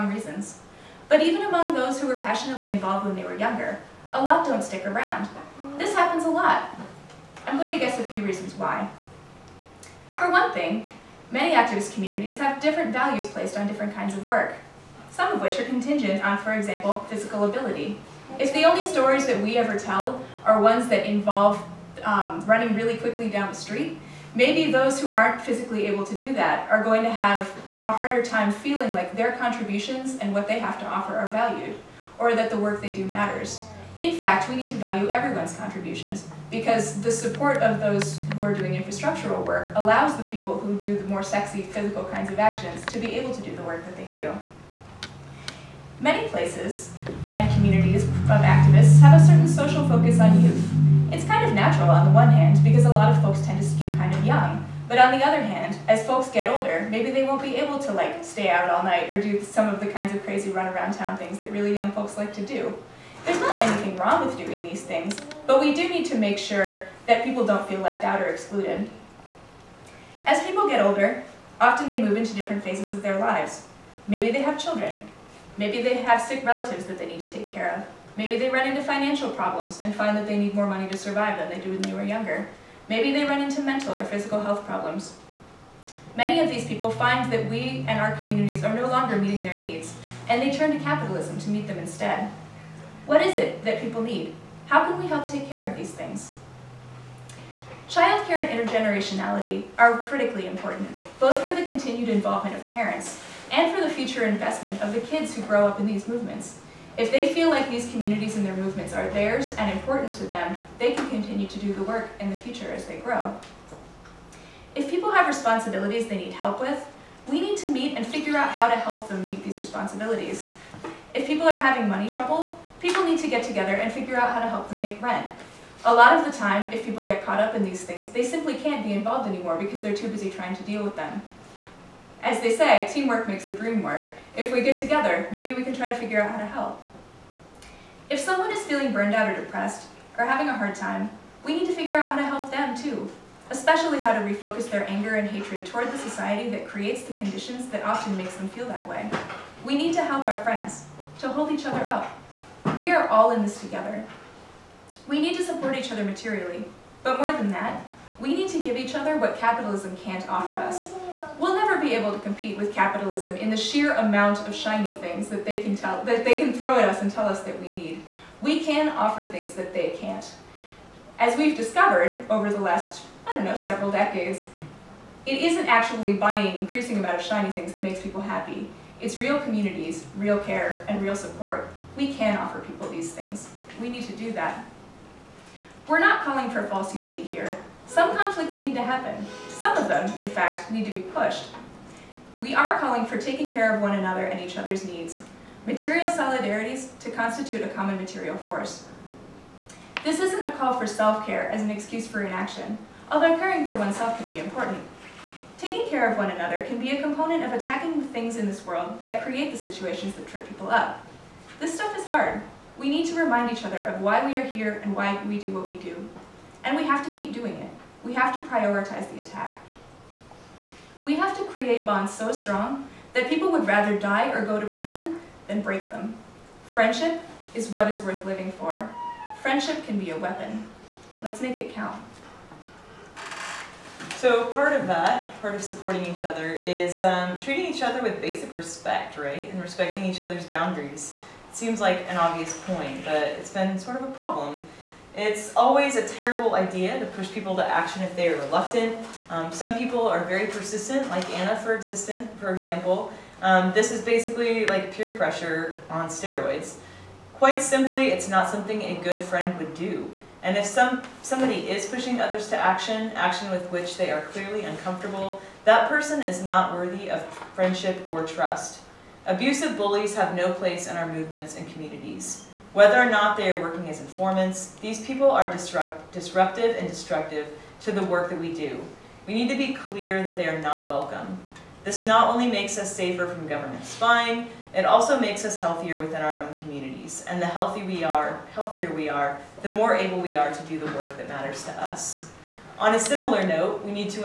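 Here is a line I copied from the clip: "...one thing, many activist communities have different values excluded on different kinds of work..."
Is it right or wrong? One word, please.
wrong.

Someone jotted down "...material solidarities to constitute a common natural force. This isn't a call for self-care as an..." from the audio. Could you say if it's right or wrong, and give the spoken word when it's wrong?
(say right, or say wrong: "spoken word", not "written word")
wrong: "material", not "natural".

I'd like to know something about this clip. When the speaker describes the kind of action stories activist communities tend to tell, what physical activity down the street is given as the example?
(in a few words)
running really quickly.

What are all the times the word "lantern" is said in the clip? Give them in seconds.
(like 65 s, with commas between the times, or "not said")
not said.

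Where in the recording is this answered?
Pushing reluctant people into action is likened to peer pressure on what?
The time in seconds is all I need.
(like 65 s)
256 s.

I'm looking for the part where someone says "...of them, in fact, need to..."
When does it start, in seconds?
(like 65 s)
189 s.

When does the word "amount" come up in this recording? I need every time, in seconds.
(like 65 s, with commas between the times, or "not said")
163 s, 176 s.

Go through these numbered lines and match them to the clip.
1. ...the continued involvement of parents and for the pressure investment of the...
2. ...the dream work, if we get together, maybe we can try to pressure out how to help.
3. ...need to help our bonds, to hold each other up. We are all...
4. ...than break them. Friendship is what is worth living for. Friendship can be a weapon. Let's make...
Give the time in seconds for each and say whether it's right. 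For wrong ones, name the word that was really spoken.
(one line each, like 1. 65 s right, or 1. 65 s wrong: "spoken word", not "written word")
1. 101 s wrong: "future", not "pressure"
2. 133 s wrong: "figure", not "pressure"
3. 149 s wrong: "friends", not "bonds"
4. 225 s right.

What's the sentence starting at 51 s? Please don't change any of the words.
It's kind of natural on the one hand, because a lot of folks tend to skew kind of young.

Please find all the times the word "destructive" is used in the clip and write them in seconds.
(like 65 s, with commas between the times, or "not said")
276 s.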